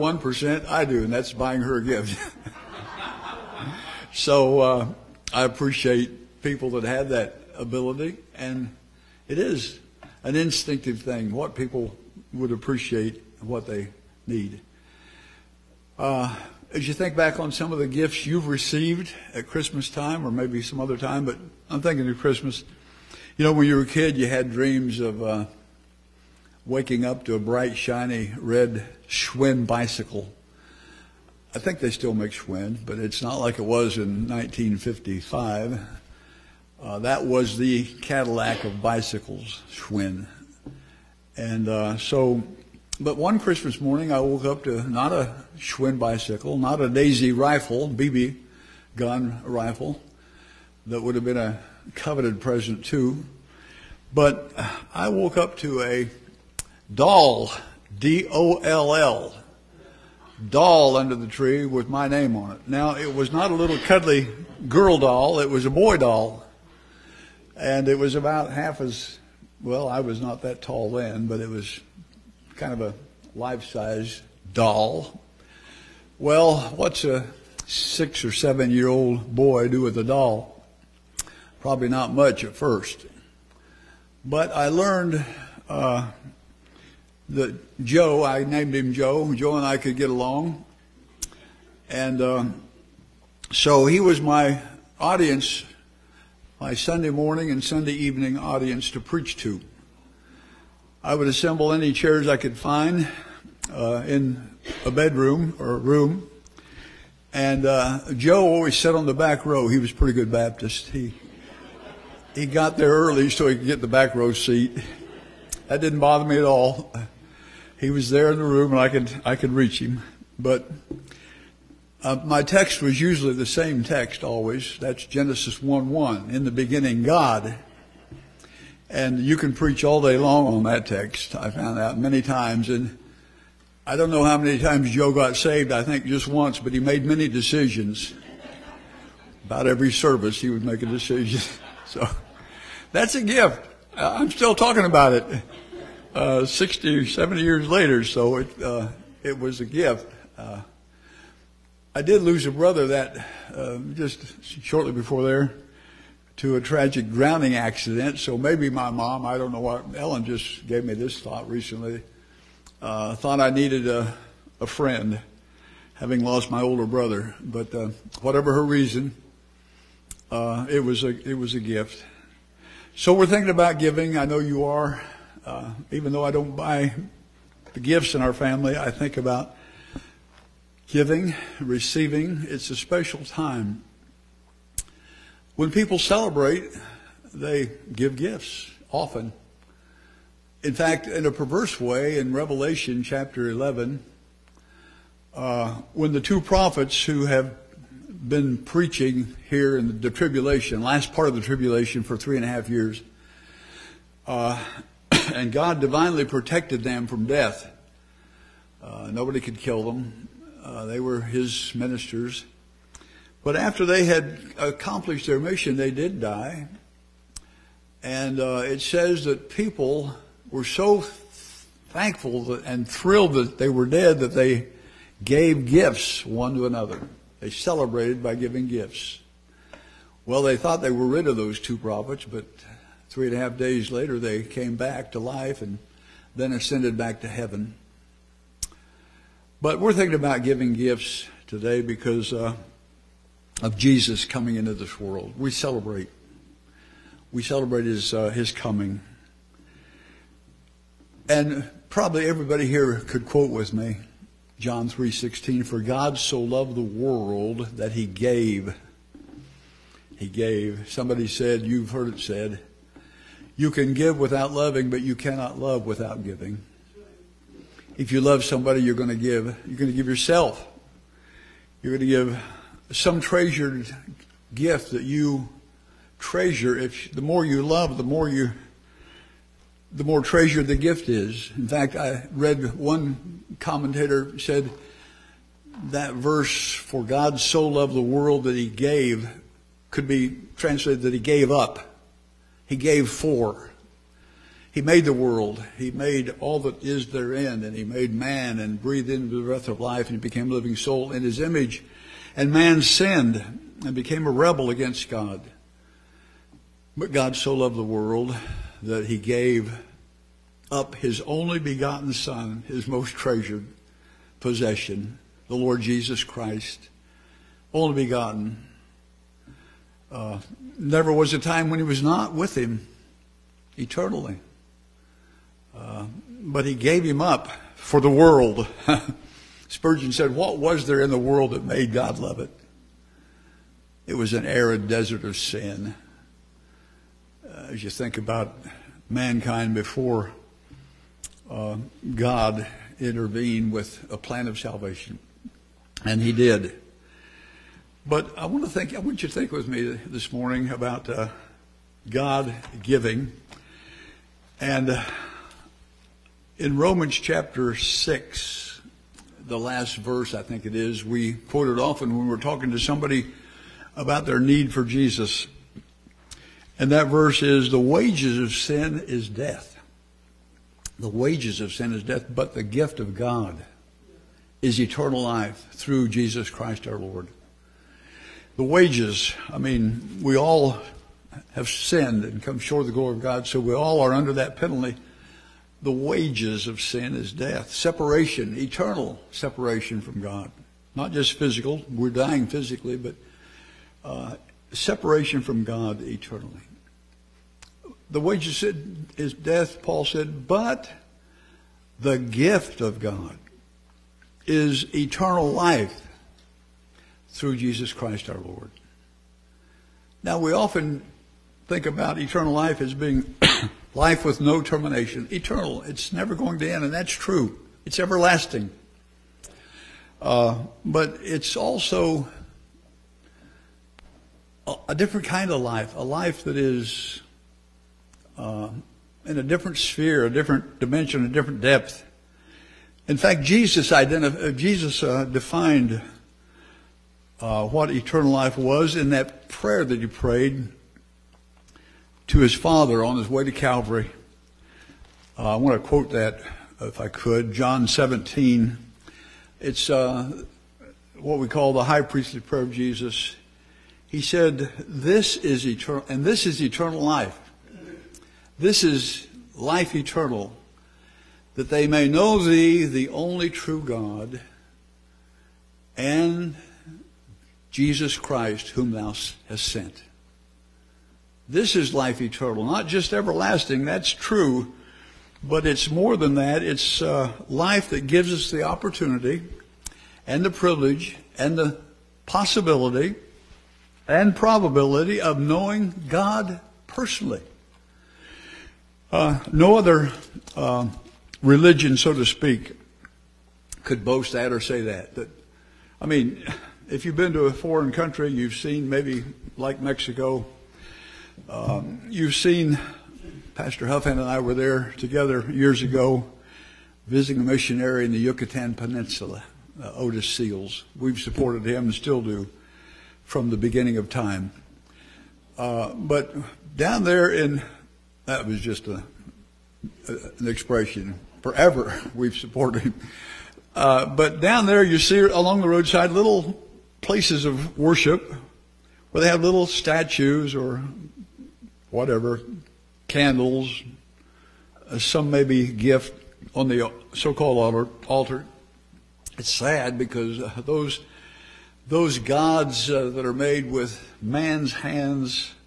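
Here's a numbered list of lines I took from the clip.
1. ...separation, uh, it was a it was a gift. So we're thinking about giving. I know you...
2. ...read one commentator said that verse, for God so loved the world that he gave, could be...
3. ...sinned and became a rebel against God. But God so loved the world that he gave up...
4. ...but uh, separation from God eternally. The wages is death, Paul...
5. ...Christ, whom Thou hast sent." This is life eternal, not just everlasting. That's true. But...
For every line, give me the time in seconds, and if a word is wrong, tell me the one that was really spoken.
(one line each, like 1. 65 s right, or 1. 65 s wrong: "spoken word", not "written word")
1. 168 s wrong: "reason", not "separation"
2. 282 s right
3. 302 s right
4. 392 s right
5. 468 s right.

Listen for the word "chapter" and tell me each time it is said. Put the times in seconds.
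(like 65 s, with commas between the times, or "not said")
193 s, 357 s.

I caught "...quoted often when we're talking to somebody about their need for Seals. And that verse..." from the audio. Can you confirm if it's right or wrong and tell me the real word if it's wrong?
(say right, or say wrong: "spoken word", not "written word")
wrong: "Jesus", not "Seals".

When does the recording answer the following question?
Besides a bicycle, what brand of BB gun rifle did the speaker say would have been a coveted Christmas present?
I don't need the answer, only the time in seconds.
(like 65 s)
46 s.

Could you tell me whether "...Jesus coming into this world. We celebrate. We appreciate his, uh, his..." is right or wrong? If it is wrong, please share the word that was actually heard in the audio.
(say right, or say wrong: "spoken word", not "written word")
wrong: "celebrate", not "appreciate".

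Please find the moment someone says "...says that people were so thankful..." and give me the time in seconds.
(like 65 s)
218 s.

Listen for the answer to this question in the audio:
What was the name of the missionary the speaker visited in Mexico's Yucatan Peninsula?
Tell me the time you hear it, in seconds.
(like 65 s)
509 s.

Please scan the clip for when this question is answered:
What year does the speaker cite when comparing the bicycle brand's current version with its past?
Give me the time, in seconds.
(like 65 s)
34 s.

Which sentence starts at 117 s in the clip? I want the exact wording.
He was there in the room, and I could I could reach him.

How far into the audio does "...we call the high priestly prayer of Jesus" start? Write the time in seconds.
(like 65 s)
451 s.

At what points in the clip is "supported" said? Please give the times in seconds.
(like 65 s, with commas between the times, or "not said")
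511 s, 522 s.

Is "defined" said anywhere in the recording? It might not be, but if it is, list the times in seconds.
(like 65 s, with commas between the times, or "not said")
435 s.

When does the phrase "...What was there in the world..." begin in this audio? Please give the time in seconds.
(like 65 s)
330 s.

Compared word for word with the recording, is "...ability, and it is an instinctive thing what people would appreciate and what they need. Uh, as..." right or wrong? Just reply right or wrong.
right.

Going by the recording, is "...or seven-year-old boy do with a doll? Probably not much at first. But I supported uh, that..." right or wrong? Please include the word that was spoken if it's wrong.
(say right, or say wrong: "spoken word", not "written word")
wrong: "learned", not "supported".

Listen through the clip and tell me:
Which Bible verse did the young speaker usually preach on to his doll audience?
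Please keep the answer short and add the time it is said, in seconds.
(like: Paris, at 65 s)
Genesis 1:1, at 125 s.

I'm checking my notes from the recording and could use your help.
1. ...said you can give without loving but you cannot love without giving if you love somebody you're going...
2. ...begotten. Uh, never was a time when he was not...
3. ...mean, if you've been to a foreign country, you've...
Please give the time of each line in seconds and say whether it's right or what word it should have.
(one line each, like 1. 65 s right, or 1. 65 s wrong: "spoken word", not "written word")
1. 262 s right
2. 318 s right
3. 496 s right.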